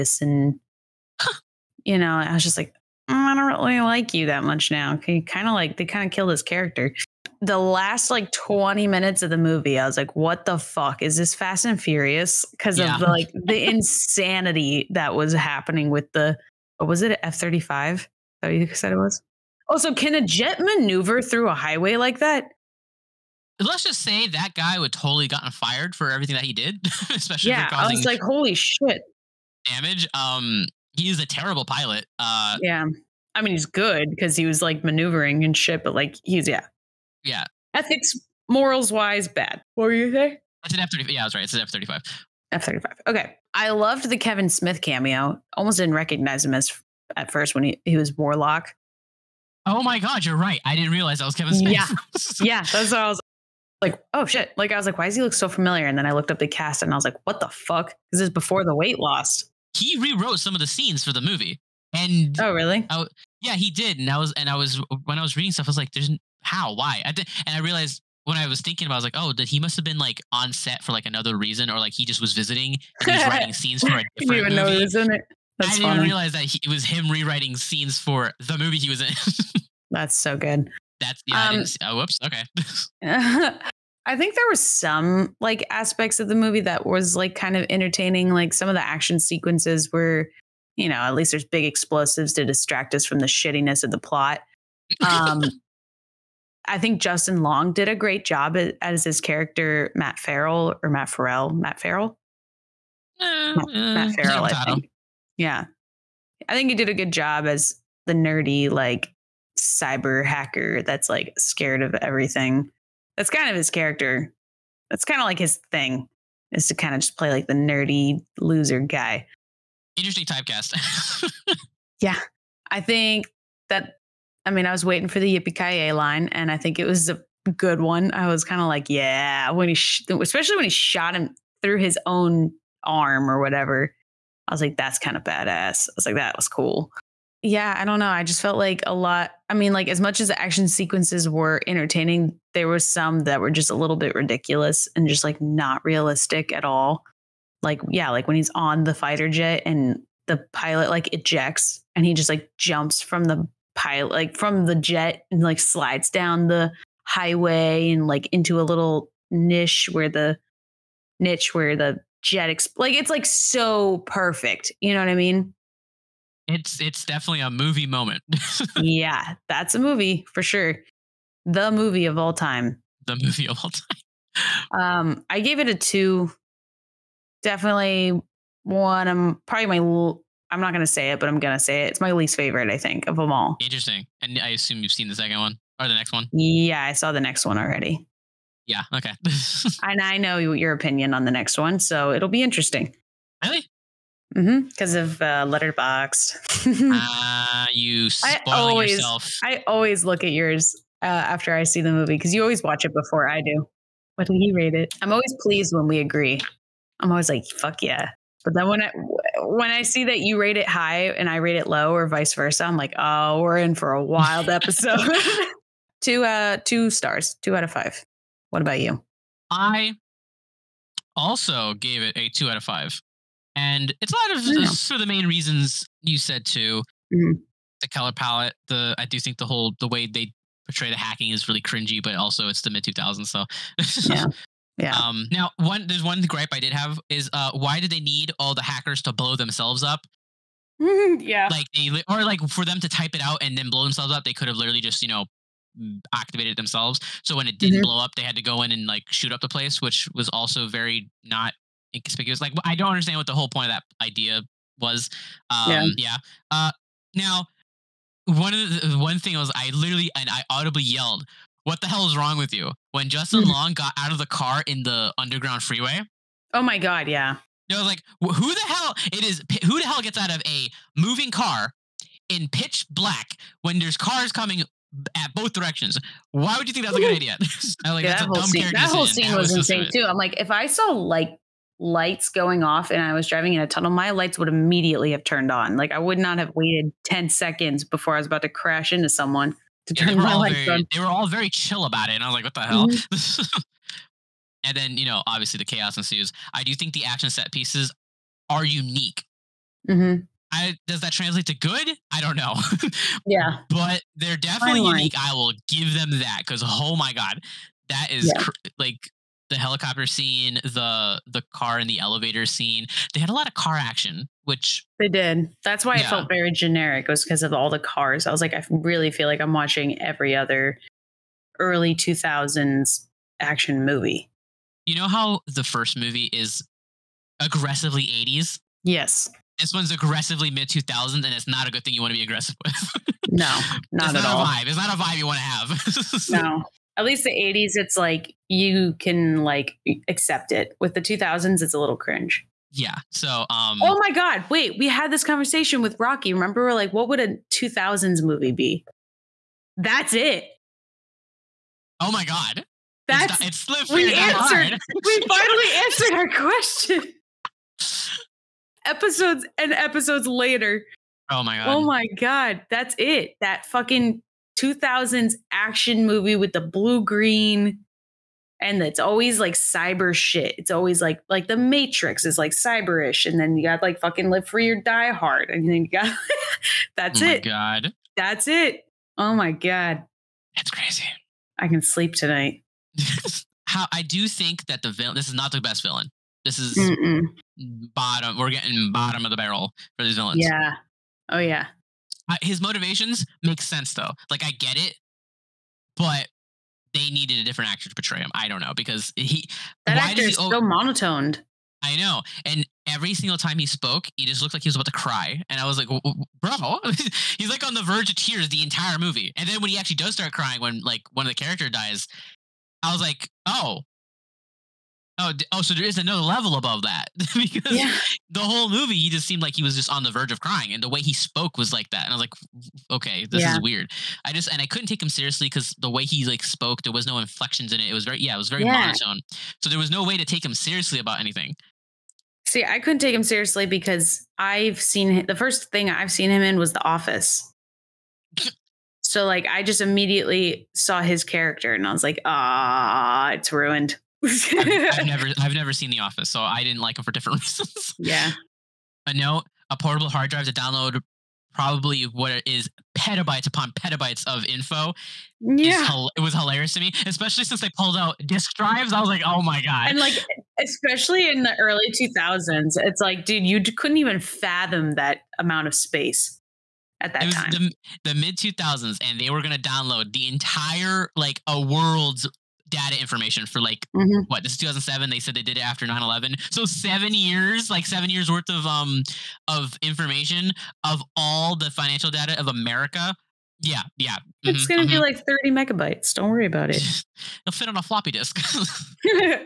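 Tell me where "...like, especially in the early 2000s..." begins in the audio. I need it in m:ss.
7:39.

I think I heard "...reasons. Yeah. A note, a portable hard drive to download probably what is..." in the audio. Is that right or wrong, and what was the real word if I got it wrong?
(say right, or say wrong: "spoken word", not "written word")
right.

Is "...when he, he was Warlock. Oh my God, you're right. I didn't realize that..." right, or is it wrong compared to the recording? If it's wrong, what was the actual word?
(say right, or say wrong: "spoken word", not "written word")
right.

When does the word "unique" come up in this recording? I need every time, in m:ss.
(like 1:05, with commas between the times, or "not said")
4:58, 5:04.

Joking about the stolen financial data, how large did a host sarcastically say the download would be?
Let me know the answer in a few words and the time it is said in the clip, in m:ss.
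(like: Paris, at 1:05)
30 megabytes, at 8:05.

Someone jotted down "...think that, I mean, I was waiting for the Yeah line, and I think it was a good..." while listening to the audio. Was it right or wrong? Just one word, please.
wrong.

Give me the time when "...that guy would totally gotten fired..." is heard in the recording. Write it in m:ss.
0:24.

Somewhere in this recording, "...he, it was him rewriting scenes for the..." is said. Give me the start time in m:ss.
1:16.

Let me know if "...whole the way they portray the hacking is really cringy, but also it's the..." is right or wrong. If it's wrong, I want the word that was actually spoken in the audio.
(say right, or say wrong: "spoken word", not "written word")
right.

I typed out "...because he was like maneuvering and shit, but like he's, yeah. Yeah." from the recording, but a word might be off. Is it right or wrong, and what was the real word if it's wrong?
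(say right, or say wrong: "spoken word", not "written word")
right.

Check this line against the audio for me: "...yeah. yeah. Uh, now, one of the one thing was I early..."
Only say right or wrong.
wrong.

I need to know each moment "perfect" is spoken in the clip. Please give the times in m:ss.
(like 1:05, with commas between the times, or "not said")
2:43.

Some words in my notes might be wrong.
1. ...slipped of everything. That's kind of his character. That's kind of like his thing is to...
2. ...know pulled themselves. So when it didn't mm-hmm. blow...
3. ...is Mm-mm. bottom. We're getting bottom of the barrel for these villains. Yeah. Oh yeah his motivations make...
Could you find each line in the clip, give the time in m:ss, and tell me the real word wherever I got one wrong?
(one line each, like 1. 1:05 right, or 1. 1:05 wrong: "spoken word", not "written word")
1. 1:51 wrong: "scared", not "slipped"
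2. 4:05 wrong: "activated", not "pulled"
3. 6:26 right.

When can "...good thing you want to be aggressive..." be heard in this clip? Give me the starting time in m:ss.
5:31.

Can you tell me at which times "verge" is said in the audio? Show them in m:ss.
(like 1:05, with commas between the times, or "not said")
6:47, 7:00.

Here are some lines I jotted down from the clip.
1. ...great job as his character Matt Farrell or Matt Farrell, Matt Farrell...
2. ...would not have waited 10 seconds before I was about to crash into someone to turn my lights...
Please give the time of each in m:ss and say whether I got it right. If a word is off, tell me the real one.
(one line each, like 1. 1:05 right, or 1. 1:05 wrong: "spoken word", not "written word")
1. 1:37 right
2. 4:45 right.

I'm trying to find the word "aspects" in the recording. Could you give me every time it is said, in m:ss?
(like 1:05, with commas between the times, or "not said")
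1:25.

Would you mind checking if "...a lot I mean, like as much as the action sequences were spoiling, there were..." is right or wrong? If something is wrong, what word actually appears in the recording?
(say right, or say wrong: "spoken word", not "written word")
wrong: "entertaining", not "spoiling".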